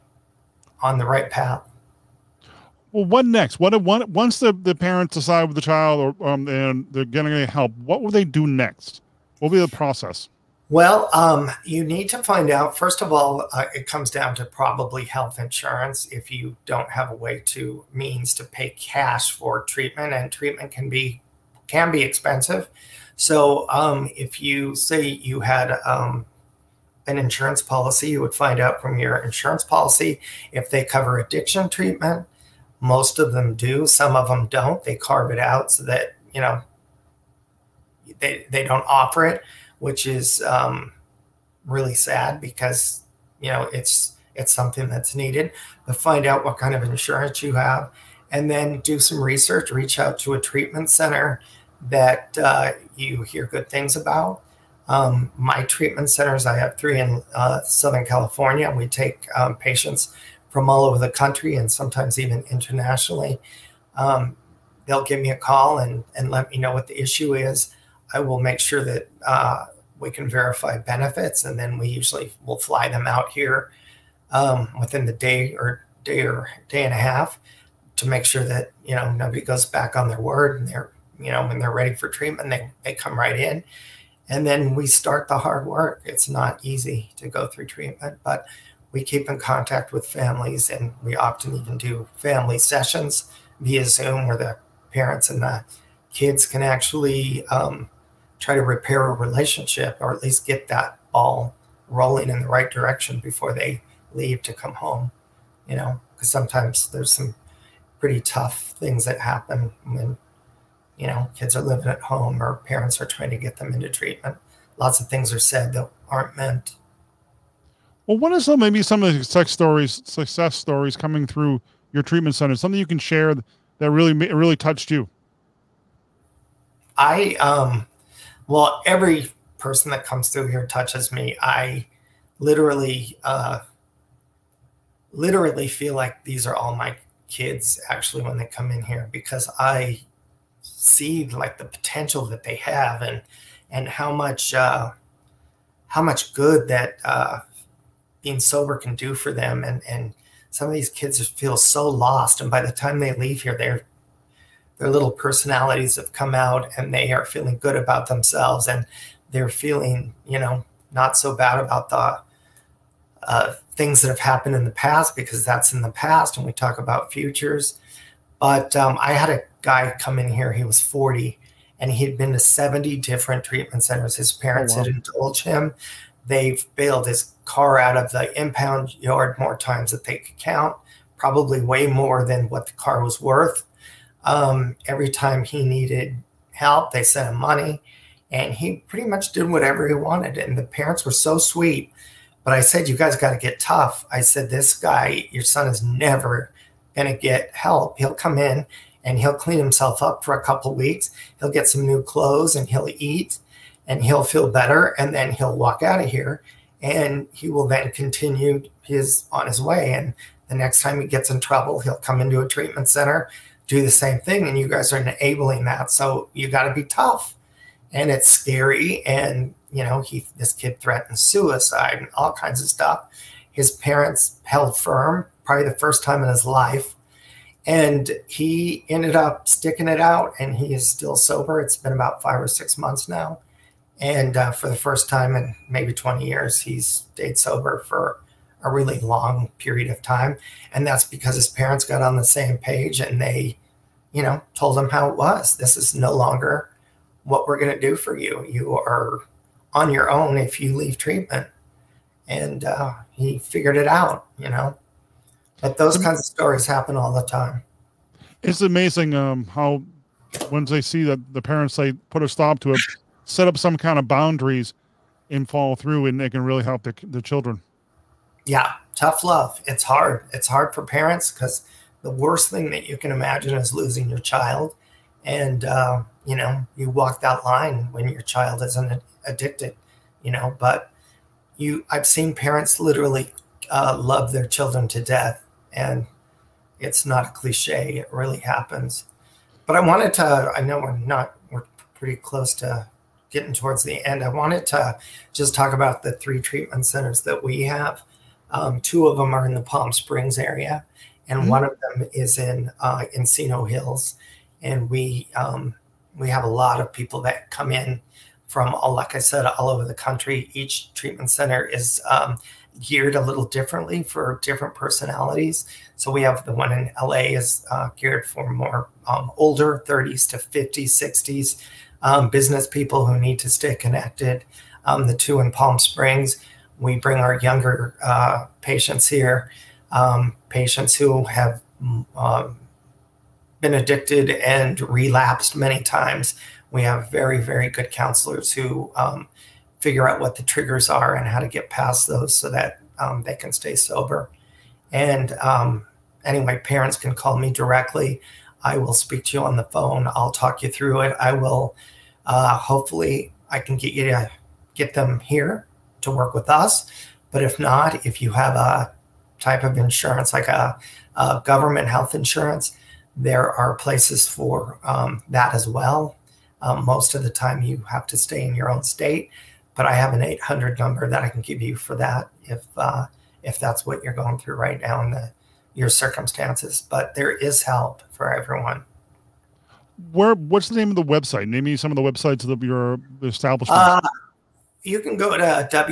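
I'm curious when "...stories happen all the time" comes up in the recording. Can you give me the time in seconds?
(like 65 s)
256 s.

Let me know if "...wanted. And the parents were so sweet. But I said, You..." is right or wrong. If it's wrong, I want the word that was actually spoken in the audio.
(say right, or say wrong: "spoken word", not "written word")
right.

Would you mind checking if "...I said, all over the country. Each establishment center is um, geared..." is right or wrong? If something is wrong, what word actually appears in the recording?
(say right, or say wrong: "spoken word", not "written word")
wrong: "treatment", not "establishment".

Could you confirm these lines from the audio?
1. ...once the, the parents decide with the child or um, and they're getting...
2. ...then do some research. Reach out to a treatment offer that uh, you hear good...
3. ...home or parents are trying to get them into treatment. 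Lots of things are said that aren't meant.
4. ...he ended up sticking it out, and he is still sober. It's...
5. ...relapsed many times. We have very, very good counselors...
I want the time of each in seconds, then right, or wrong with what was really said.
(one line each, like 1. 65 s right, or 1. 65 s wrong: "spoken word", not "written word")
1. 4 s right
2. 48 s wrong: "center", not "offer"
3. 111 s right
4. 228 s right
5. 334 s right.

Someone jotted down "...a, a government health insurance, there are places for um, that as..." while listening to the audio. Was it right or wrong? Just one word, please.
right.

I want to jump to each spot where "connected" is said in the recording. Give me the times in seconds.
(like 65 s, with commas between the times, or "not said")
323 s.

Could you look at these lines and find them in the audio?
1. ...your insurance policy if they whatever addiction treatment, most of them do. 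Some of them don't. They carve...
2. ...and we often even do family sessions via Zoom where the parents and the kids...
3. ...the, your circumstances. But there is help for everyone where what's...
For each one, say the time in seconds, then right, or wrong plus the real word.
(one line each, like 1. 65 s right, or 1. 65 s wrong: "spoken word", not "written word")
1. 28 s wrong: "cover", not "whatever"
2. 90 s right
3. 375 s right.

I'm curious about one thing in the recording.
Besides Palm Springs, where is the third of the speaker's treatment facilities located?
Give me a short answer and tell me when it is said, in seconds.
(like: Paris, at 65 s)
Encino Hills, at 303 s.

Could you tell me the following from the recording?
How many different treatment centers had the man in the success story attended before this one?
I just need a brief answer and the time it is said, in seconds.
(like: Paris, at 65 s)
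70, at 172 s.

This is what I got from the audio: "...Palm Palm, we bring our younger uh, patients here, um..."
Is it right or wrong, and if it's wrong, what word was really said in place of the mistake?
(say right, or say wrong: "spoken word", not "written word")
wrong: "Springs", not "Palm".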